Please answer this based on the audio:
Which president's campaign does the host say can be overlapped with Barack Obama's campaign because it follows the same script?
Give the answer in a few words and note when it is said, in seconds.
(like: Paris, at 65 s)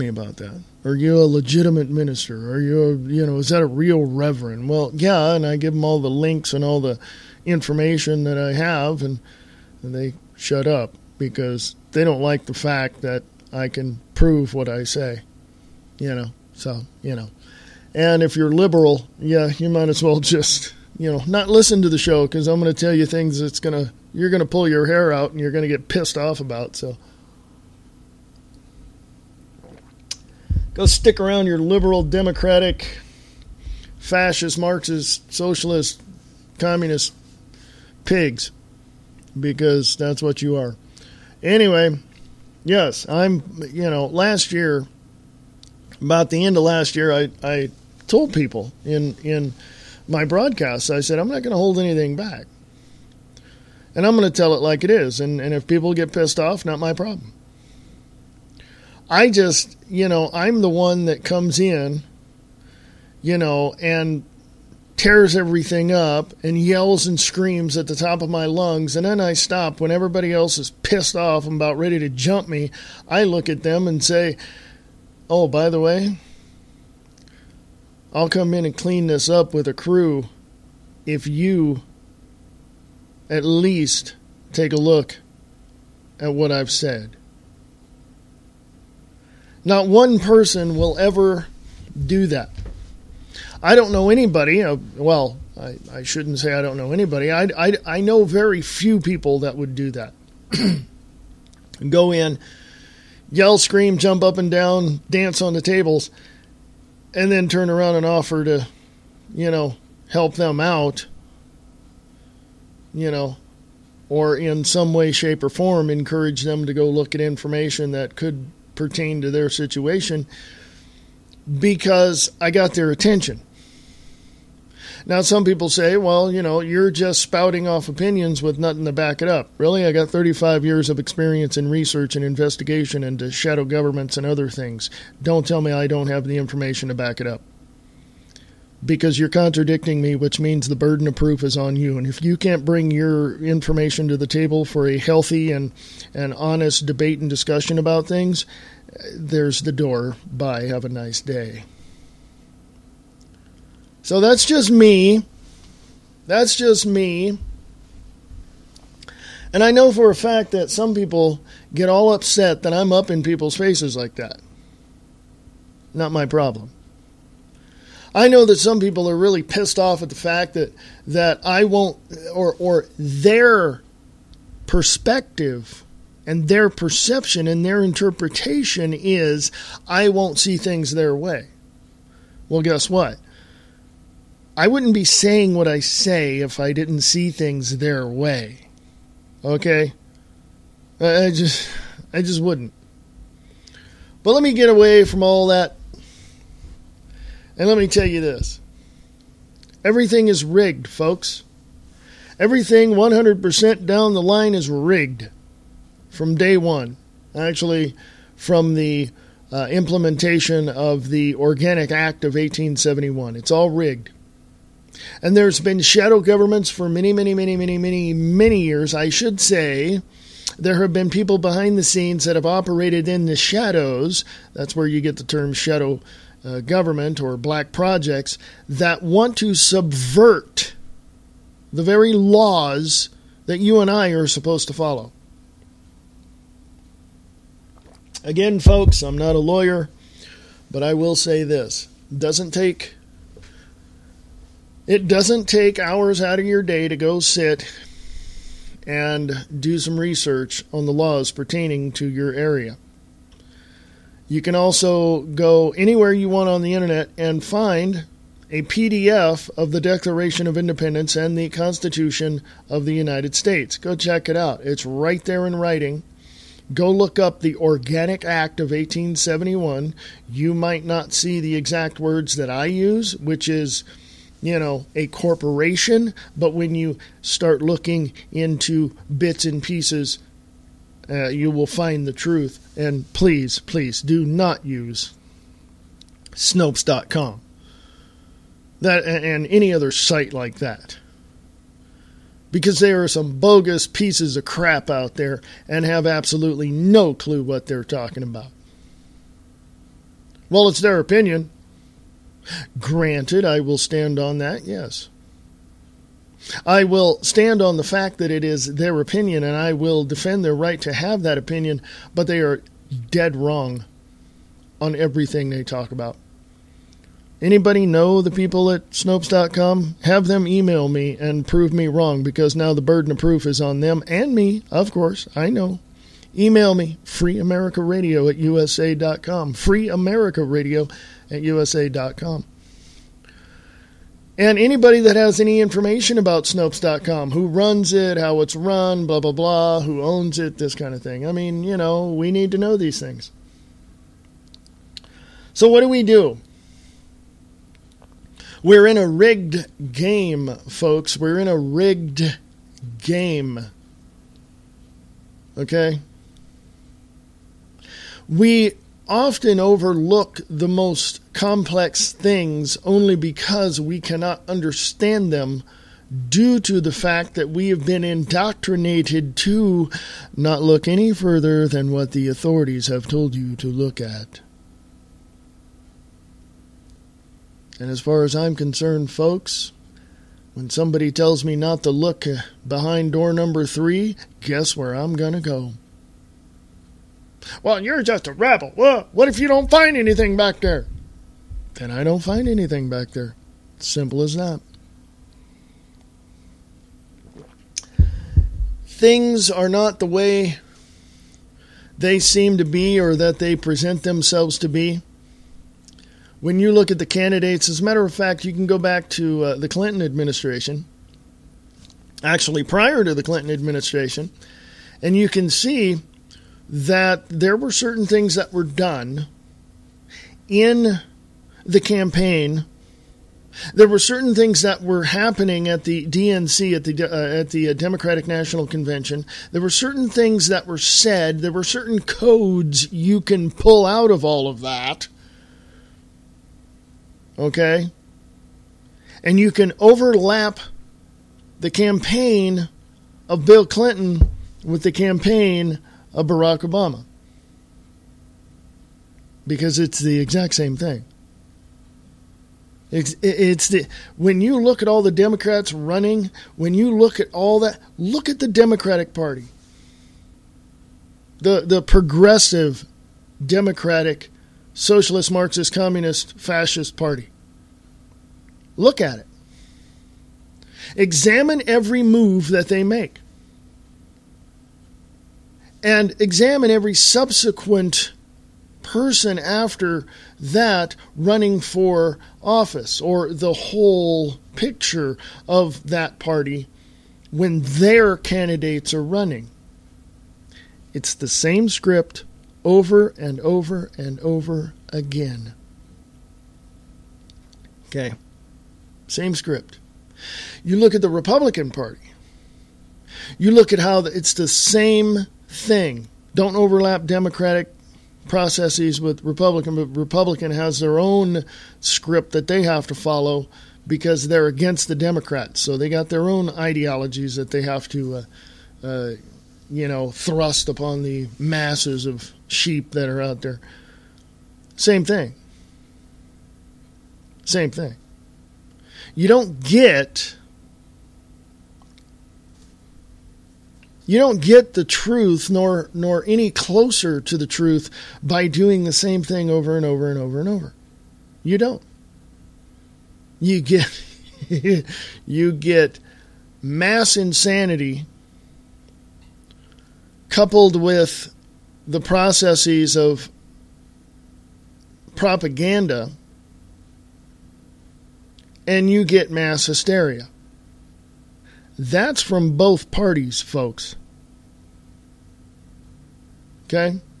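Bill Clinton, at 443 s.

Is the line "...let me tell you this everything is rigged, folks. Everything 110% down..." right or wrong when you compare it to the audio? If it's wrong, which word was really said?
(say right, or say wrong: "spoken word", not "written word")
wrong: "100", not "110".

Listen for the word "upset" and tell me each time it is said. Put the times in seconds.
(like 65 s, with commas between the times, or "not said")
162 s.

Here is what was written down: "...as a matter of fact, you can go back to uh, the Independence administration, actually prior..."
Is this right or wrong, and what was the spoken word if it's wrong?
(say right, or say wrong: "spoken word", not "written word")
wrong: "Clinton", not "Independence".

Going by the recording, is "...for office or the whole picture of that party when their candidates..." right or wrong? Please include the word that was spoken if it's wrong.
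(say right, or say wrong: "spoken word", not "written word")
right.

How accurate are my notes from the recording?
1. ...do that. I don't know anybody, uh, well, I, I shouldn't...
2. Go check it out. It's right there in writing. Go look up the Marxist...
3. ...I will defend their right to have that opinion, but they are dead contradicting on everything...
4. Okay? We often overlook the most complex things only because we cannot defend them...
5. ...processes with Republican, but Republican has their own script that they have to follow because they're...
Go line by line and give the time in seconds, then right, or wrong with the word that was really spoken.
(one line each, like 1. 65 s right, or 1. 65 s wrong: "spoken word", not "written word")
1. 92 s right
2. 263 s wrong: "Organic", not "Marxist"
3. 309 s wrong: "wrong", not "contradicting"
4. 355 s wrong: "understand", not "defend"
5. 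508 s right.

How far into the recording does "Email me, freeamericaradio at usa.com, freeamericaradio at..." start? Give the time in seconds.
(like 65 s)
326 s.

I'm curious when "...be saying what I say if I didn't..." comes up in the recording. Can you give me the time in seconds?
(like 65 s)
184 s.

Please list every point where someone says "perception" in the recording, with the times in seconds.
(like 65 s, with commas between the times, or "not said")
176 s.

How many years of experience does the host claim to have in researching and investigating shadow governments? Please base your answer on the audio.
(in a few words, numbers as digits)
35.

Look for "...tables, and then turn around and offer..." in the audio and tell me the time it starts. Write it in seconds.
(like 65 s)
105 s.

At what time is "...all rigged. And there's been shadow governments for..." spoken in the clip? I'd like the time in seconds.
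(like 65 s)
213 s.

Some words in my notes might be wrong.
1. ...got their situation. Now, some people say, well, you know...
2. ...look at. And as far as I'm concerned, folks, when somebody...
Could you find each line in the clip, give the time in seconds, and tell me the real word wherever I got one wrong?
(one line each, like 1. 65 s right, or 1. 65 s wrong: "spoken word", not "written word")
1. 122 s wrong: "attention", not "situation"
2. 373 s right.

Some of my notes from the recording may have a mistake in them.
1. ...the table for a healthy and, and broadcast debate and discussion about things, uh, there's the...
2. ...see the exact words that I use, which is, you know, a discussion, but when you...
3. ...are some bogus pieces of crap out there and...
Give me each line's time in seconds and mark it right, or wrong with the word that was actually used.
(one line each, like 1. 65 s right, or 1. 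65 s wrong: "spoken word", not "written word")
1. 144 s wrong: "honest", not "broadcast"
2. 271 s wrong: "corporation", not "discussion"
3. 293 s right.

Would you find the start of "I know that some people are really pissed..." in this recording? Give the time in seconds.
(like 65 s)
168 s.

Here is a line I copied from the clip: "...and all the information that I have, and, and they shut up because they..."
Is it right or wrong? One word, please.
right.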